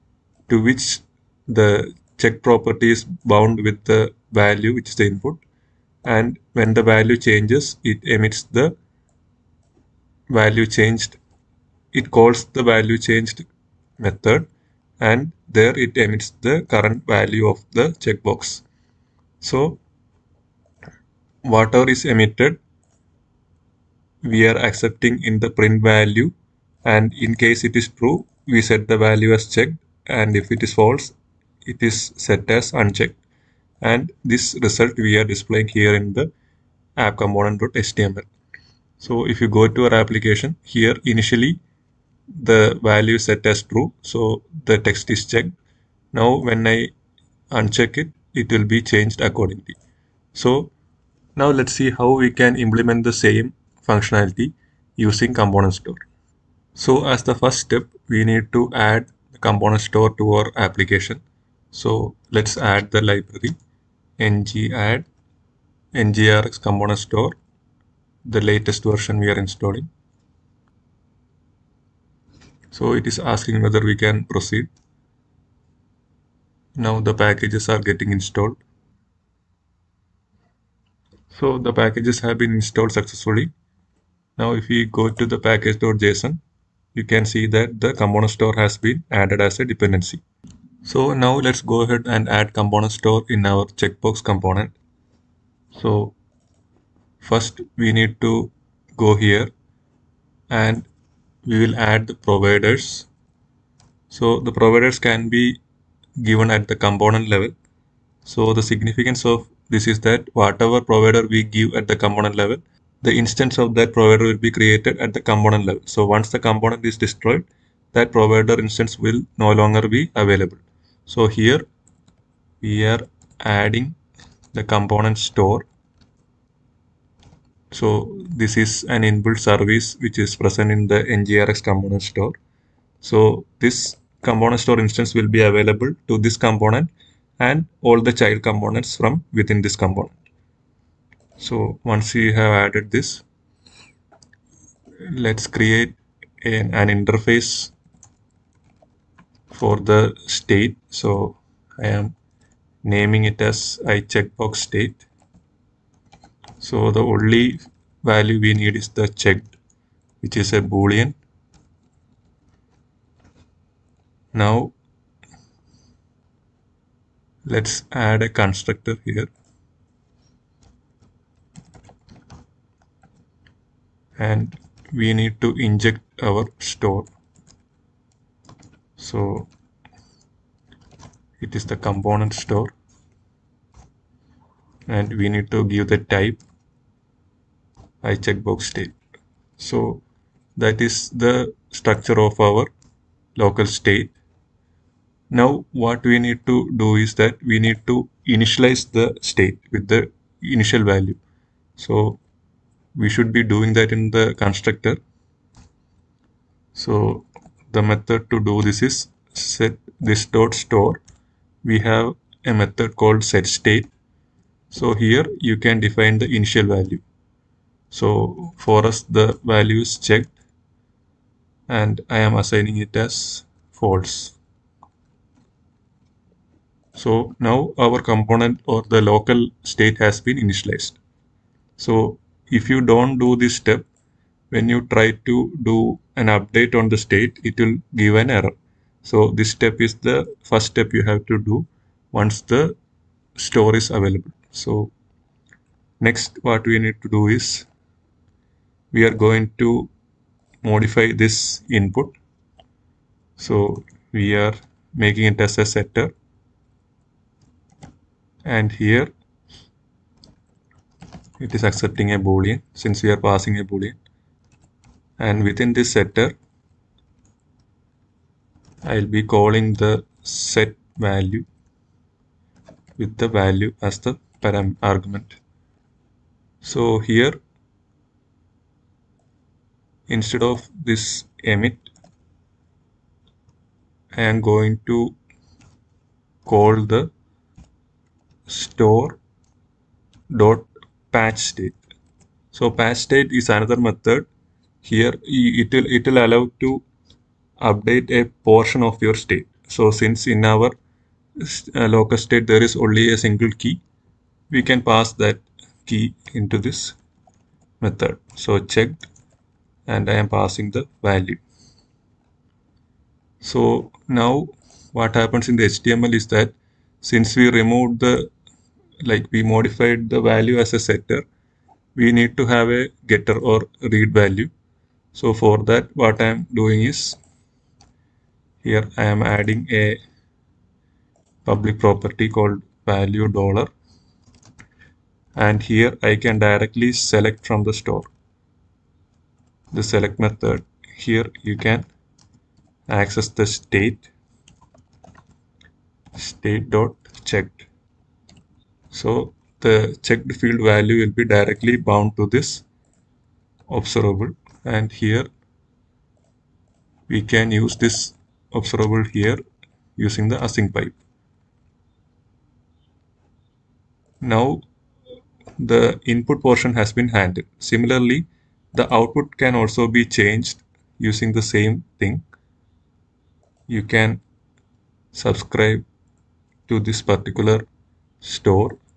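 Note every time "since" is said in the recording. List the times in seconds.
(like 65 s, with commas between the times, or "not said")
262 s, 299 s, 317 s.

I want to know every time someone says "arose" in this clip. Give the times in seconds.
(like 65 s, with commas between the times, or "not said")
not said.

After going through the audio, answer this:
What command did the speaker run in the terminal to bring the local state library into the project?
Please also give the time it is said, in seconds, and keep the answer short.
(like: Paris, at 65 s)
ng add ngrx component store, at 64 s.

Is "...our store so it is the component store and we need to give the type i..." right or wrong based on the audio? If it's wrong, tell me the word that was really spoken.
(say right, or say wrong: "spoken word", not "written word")
right.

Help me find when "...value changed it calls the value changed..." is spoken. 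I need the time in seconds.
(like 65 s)
10 s.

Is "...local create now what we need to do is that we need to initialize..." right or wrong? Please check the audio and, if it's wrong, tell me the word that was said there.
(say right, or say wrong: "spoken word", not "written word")
wrong: "state", not "create".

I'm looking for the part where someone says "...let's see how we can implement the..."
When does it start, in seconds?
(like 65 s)
51 s.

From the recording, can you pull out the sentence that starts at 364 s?
Now the input portion has been handled.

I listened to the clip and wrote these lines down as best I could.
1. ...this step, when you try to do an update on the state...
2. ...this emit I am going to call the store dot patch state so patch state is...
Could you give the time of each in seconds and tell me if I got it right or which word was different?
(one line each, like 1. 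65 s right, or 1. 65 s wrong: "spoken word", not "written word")
1. 233 s right
2. 280 s right.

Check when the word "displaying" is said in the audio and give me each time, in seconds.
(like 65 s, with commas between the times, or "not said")
35 s.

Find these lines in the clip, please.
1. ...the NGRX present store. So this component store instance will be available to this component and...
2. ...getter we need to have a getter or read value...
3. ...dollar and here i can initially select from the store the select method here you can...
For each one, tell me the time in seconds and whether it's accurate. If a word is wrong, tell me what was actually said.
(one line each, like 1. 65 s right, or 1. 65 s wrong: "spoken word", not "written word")
1. 130 s wrong: "component", not "present"
2. 320 s wrong: "setter", not "getter"
3. 333 s wrong: "directly", not "initially".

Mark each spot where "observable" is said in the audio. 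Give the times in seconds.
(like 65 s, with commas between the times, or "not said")
353 s, 358 s.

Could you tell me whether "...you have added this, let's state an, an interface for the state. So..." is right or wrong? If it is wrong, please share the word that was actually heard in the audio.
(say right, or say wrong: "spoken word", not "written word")
wrong: "create", not "state".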